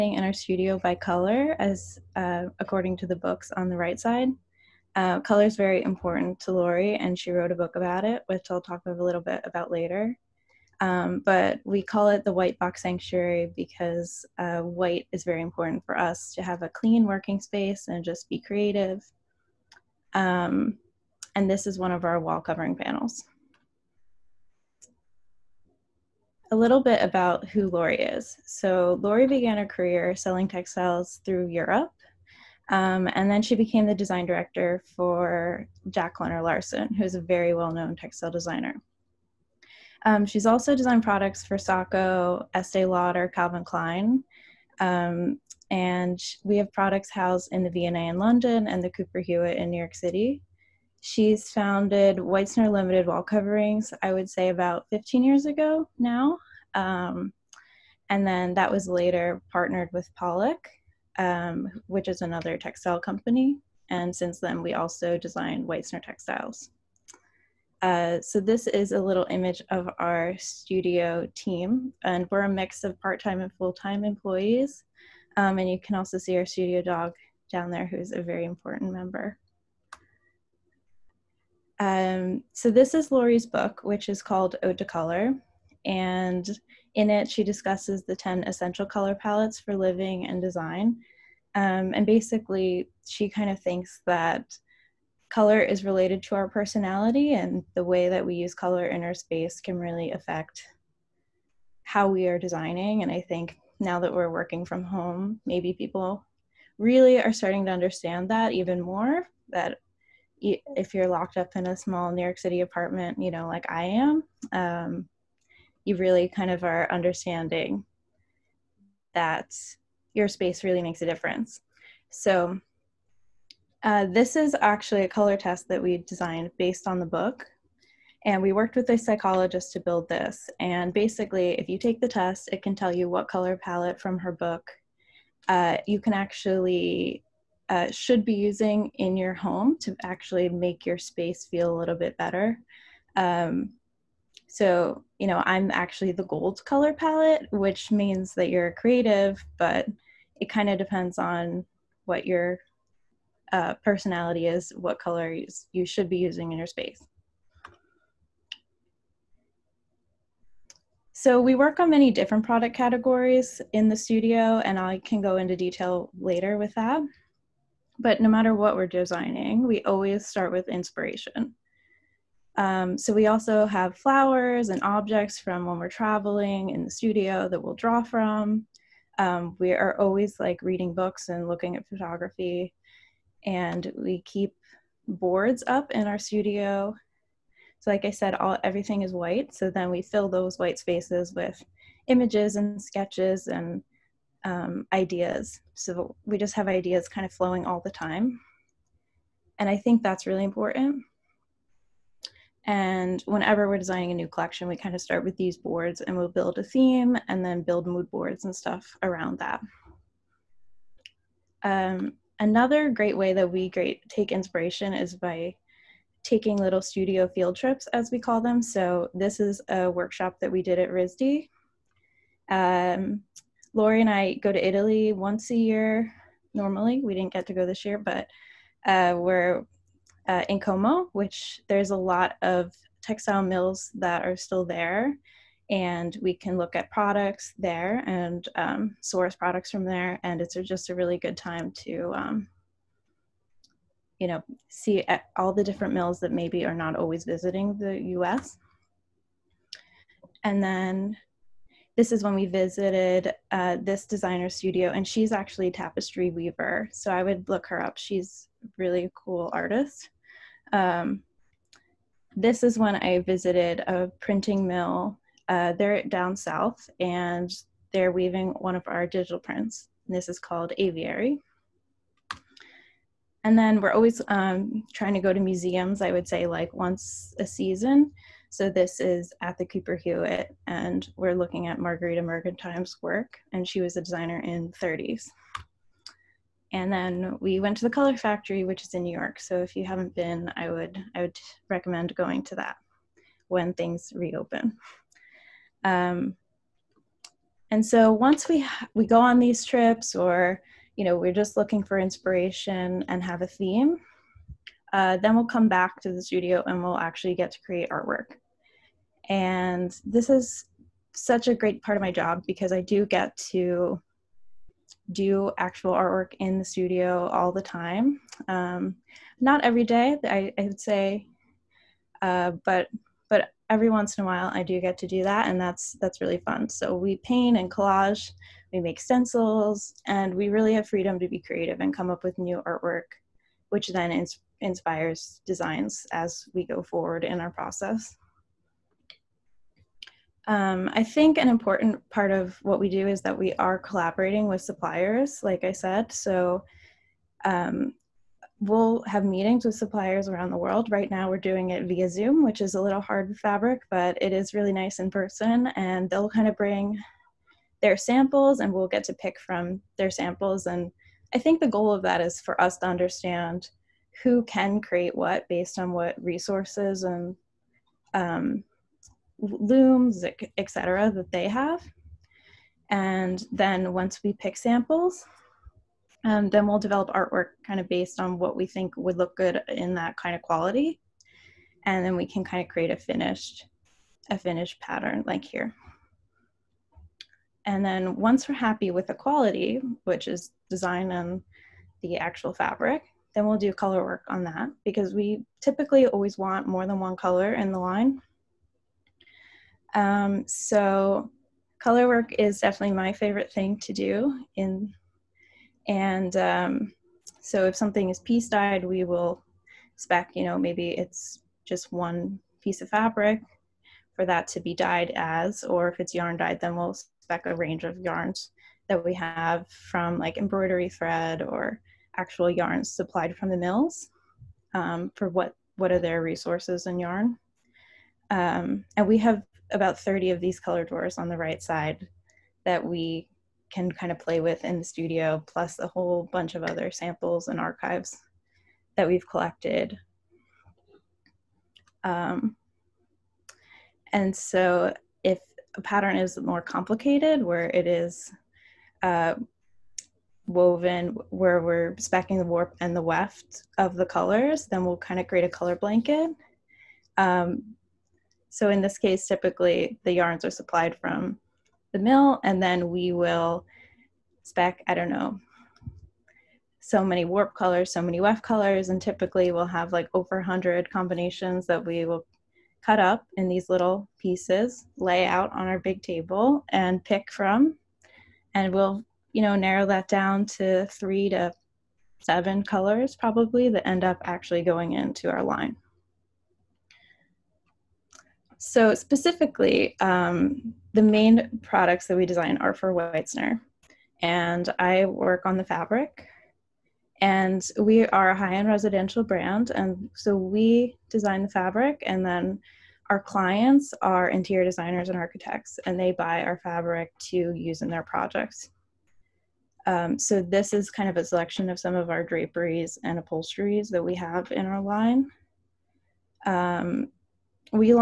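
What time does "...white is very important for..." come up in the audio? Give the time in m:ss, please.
0:14.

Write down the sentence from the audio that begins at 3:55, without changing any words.
And we can look at products there and um, source products from there.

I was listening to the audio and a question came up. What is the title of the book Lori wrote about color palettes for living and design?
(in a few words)
Ode to Color.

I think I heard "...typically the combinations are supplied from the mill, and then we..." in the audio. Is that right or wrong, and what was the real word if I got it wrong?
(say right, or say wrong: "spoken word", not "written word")
wrong: "yarns", not "combinations".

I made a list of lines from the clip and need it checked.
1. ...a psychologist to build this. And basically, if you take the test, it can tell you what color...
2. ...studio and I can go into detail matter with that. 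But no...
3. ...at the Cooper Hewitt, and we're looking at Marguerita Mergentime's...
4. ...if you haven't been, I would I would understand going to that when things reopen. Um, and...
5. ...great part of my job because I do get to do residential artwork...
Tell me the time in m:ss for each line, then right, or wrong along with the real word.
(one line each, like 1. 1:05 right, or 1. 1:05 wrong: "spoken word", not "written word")
1. 2:08 right
2. 2:43 wrong: "later", not "matter"
3. 4:39 right
4. 4:49 wrong: "recommend", not "understand"
5. 5:11 wrong: "actual", not "residential".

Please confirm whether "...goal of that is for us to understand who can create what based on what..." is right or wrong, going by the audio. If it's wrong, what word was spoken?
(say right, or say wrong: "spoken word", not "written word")
right.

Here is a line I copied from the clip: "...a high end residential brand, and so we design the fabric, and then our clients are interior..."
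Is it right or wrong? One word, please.
right.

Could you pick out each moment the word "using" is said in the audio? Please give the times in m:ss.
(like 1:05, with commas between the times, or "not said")
2:18, 2:36.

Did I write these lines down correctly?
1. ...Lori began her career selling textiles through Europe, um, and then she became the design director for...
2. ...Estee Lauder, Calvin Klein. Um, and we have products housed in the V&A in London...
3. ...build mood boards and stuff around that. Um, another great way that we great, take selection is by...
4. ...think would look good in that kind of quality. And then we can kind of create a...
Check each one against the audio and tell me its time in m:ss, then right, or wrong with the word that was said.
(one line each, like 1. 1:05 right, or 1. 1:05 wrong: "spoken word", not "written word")
1. 0:29 right
2. 0:42 right
3. 3:27 wrong: "inspiration", not "selection"
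4. 6:18 right.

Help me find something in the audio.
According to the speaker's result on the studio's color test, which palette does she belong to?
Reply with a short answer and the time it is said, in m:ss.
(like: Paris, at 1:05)
Gold, at 2:26.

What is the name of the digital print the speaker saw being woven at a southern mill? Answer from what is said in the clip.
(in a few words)
Aviary.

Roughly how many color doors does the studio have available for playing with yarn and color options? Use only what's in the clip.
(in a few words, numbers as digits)
30.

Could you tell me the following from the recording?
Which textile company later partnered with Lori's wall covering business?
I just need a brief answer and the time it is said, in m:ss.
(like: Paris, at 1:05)
Pollack, at 1:00.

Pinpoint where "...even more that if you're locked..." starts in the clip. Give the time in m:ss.
1:48.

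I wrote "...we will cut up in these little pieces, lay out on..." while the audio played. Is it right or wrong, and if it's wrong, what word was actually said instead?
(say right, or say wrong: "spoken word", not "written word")
right.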